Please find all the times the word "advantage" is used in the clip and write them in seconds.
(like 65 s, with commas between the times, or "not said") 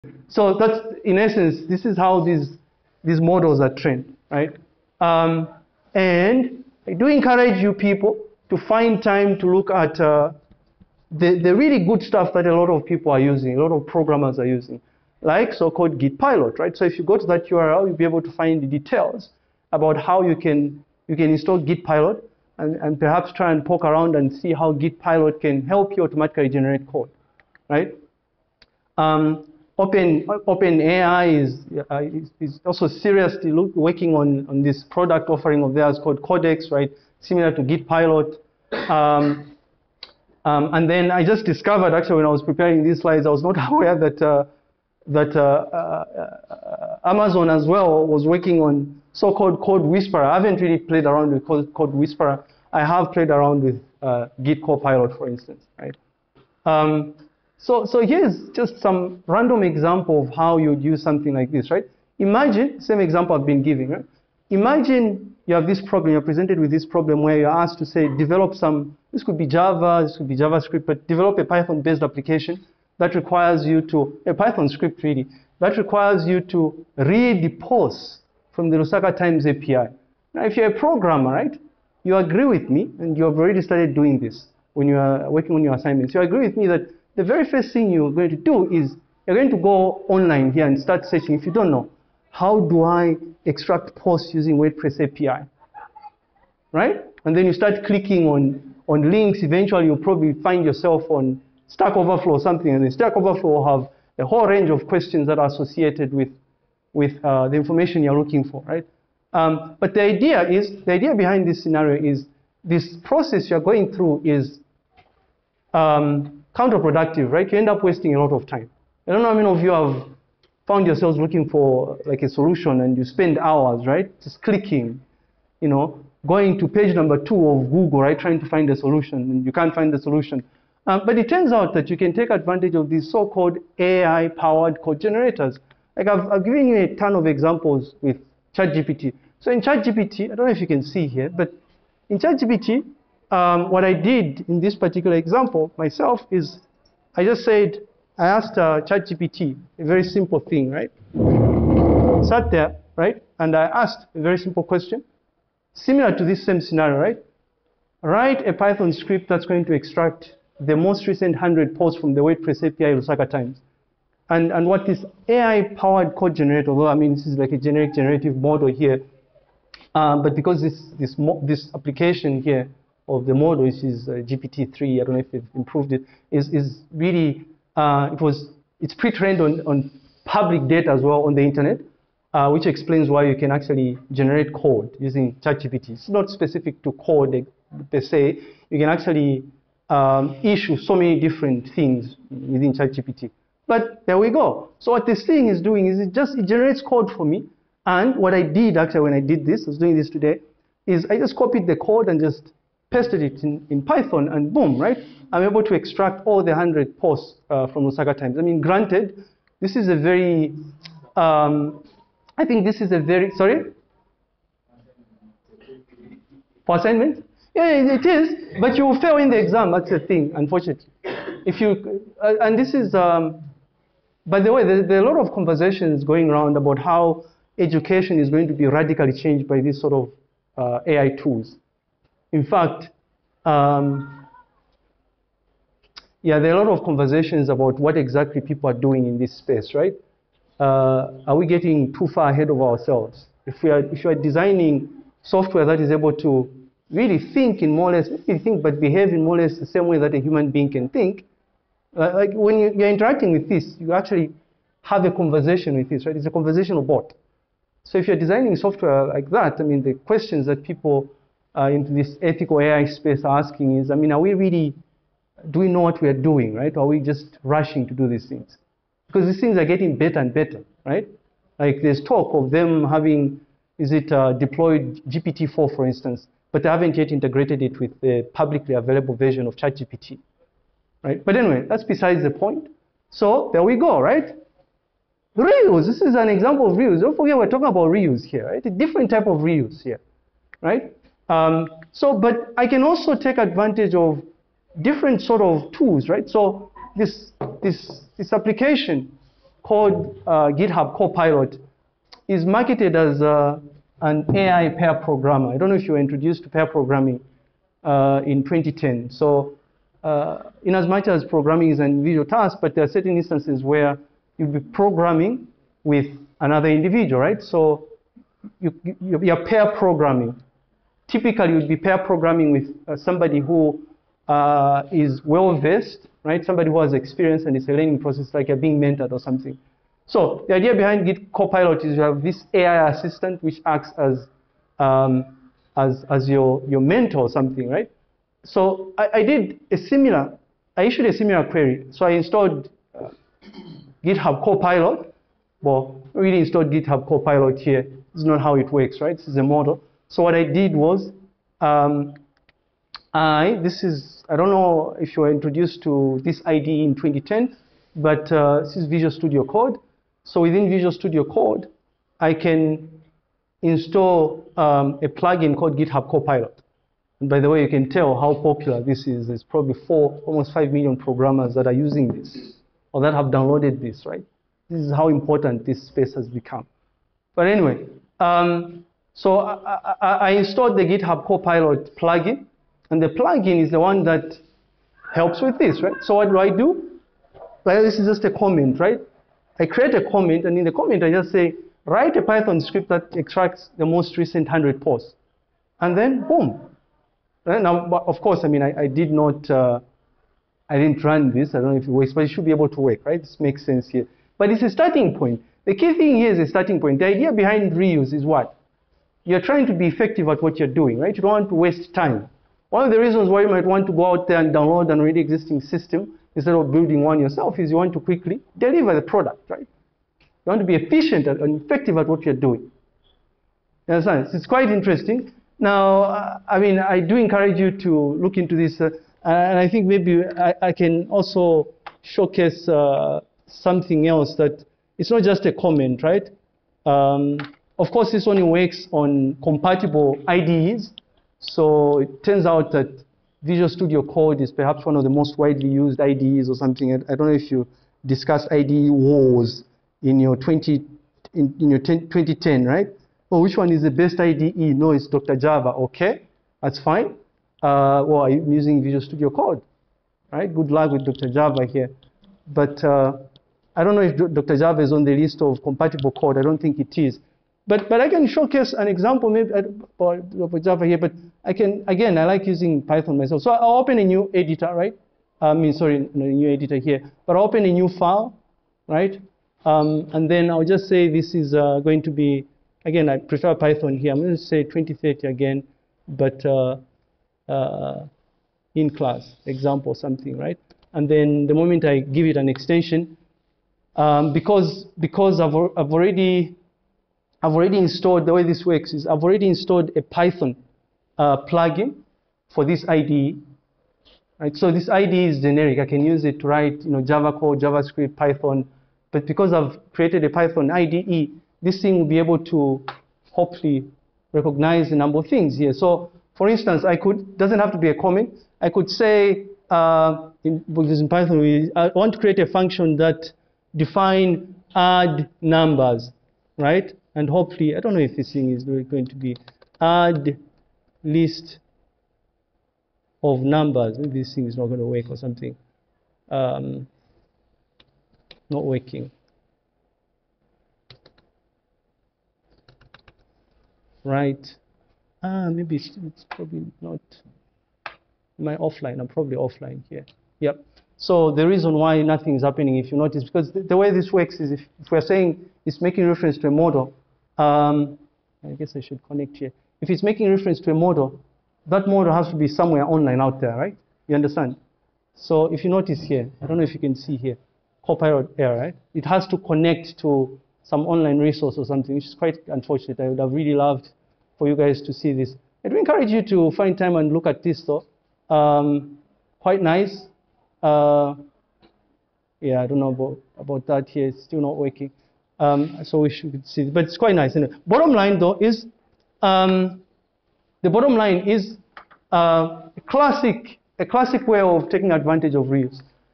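132 s, 293 s, 594 s.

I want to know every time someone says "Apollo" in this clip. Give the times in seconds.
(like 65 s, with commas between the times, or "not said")
not said.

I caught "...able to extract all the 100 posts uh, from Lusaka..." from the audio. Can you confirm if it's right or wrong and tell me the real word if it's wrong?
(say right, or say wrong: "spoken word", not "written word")
right.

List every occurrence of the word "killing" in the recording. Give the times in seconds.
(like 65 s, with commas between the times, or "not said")
not said.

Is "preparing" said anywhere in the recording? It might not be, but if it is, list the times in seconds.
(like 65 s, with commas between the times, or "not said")
42 s.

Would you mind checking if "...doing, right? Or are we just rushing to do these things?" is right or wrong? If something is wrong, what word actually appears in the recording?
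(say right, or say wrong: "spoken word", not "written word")
right.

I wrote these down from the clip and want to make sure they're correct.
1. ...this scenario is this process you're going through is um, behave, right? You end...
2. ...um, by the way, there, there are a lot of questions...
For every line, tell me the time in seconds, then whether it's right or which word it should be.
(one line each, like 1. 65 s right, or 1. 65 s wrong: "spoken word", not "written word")
1. 111 s wrong: "counterproductive", not "behave"
2. 222 s wrong: "conversations", not "questions".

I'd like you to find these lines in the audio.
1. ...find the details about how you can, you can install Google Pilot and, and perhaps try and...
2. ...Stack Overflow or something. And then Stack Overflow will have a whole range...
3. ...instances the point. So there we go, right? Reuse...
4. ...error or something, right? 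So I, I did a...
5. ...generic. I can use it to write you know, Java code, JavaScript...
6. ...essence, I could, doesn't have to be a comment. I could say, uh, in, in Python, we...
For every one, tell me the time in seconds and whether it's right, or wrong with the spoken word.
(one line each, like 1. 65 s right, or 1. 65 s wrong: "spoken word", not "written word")
1. 18 s wrong: "Git", not "Google"
2. 101 s right
3. 281 s wrong: "besides", not "instances"
4. 336 s wrong: "mentor", not "error"
5. 505 s right
6. 516 s wrong: "instance", not "essence".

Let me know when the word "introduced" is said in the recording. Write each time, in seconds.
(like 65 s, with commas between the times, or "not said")
305 s, 355 s.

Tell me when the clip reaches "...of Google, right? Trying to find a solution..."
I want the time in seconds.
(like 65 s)
127 s.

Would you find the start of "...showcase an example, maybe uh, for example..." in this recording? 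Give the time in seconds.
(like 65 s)
468 s.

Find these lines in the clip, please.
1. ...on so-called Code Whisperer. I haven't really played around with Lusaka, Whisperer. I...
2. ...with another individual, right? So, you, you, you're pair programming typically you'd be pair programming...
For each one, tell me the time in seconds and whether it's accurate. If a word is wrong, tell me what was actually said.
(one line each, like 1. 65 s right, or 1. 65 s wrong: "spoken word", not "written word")
1. 48 s wrong: "Code", not "Lusaka"
2. 315 s right.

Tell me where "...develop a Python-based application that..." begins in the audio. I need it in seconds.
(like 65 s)
71 s.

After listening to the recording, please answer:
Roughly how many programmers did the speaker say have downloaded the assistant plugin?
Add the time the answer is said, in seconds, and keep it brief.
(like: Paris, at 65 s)
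almost 5 million, at 370 s.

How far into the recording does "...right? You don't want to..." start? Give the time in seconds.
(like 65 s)
410 s.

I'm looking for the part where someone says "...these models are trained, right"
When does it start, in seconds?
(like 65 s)
3 s.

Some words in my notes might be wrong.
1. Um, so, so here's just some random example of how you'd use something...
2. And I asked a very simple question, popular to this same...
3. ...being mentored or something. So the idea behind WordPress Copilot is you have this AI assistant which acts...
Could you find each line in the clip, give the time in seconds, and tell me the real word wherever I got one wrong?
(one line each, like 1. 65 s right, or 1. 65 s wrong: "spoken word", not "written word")
1. 56 s right
2. 153 s wrong: "similar", not "popular"
3. 328 s wrong: "Git", not "WordPress".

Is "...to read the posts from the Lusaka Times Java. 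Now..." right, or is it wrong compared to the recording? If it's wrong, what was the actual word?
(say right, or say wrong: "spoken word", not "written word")
wrong: "API", not "Java".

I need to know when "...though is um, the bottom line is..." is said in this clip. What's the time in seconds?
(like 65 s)
588 s.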